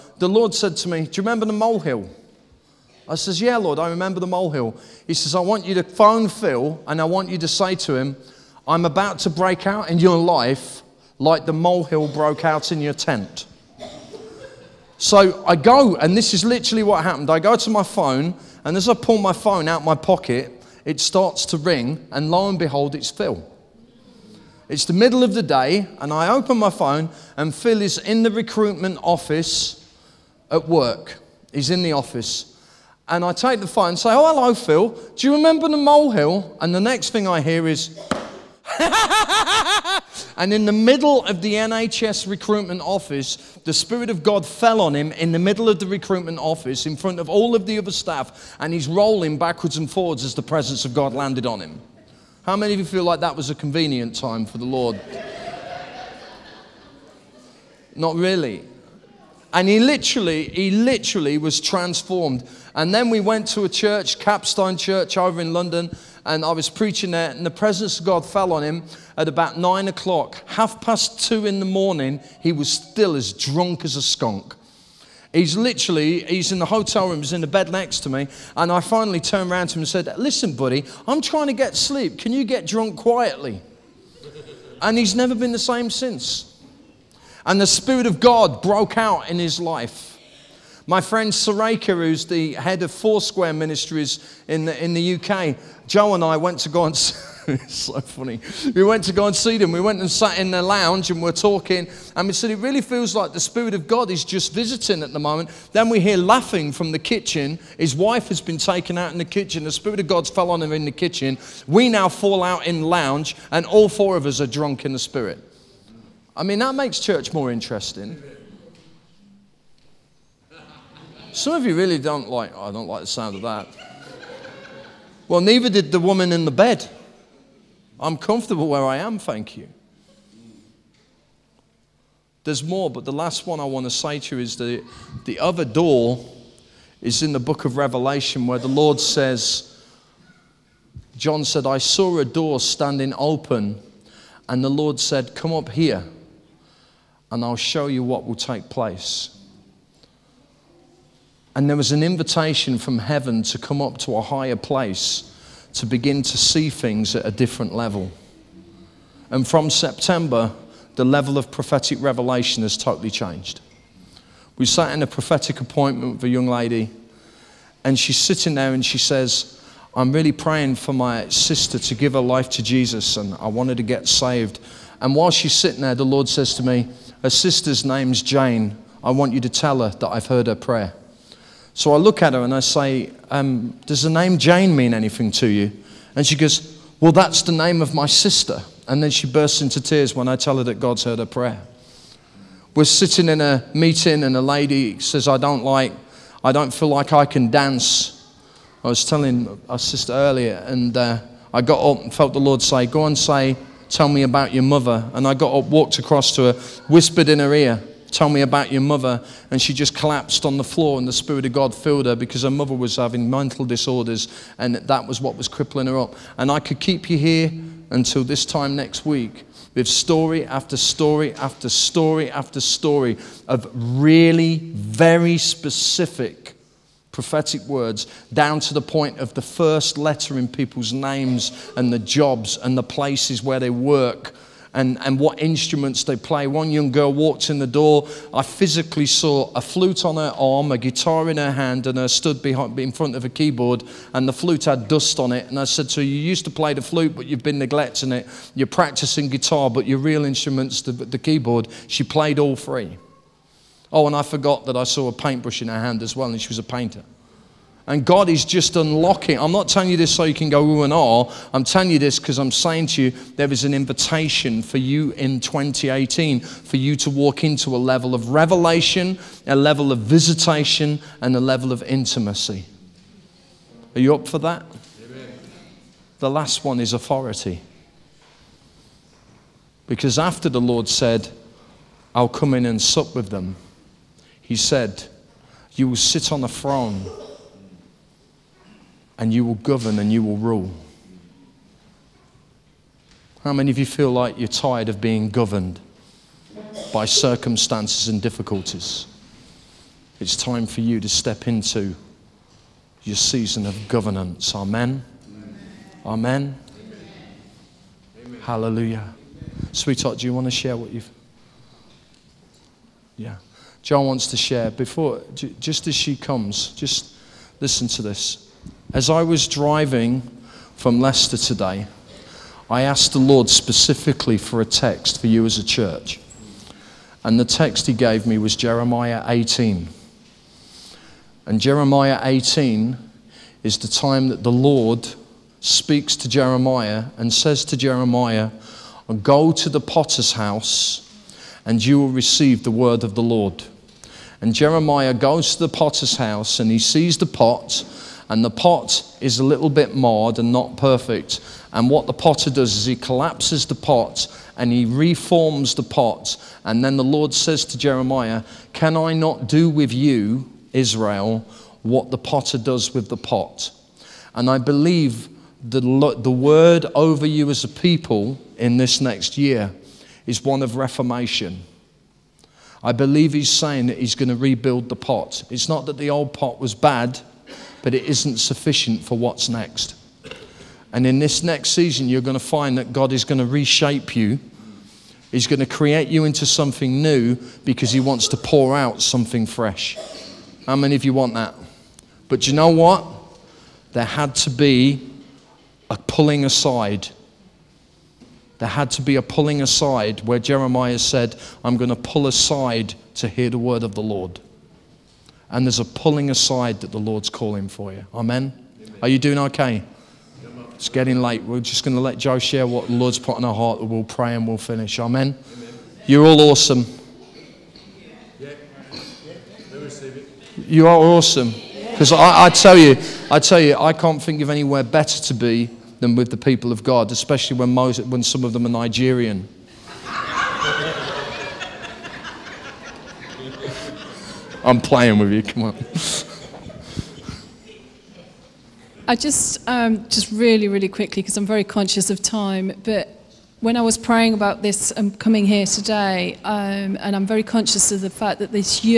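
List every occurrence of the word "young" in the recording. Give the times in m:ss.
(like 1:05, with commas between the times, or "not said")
2:46, 3:56.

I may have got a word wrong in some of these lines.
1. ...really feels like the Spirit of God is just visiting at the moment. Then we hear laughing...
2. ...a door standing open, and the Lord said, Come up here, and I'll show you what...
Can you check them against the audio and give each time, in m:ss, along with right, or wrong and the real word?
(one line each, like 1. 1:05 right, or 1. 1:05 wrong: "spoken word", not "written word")
1. 1:42 right
2. 2:22 right.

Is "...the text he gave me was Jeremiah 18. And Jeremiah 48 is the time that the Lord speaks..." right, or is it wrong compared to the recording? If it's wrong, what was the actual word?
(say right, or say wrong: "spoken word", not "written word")
wrong: "18", not "48".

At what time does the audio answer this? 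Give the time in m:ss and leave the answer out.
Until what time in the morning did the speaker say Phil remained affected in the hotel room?
1:10.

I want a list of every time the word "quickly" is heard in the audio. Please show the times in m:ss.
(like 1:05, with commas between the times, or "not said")
7:20.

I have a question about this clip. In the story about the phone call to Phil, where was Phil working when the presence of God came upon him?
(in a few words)
NHS recruitment office.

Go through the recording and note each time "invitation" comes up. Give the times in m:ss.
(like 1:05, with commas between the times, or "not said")
2:32, 4:23.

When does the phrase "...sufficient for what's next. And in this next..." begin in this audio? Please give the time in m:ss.
6:18.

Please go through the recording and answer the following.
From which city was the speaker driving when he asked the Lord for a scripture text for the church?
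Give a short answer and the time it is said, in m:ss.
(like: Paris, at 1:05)
Leicester, at 5:20.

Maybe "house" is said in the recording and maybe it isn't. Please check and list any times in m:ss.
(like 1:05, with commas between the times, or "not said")
5:40, 5:46.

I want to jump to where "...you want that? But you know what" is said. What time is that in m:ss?
6:31.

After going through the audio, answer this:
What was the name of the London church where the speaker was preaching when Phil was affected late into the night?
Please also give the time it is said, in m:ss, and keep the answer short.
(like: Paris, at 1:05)
Capstone Church, at 1:04.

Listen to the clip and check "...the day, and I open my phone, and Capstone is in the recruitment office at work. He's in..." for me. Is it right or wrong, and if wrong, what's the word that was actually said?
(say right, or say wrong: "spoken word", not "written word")
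wrong: "Phil", not "Capstone".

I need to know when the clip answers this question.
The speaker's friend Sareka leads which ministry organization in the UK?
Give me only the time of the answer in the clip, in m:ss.
1:32.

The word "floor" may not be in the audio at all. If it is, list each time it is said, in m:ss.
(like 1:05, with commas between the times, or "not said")
3:30.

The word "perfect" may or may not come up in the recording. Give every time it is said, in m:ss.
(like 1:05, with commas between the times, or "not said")
5:50.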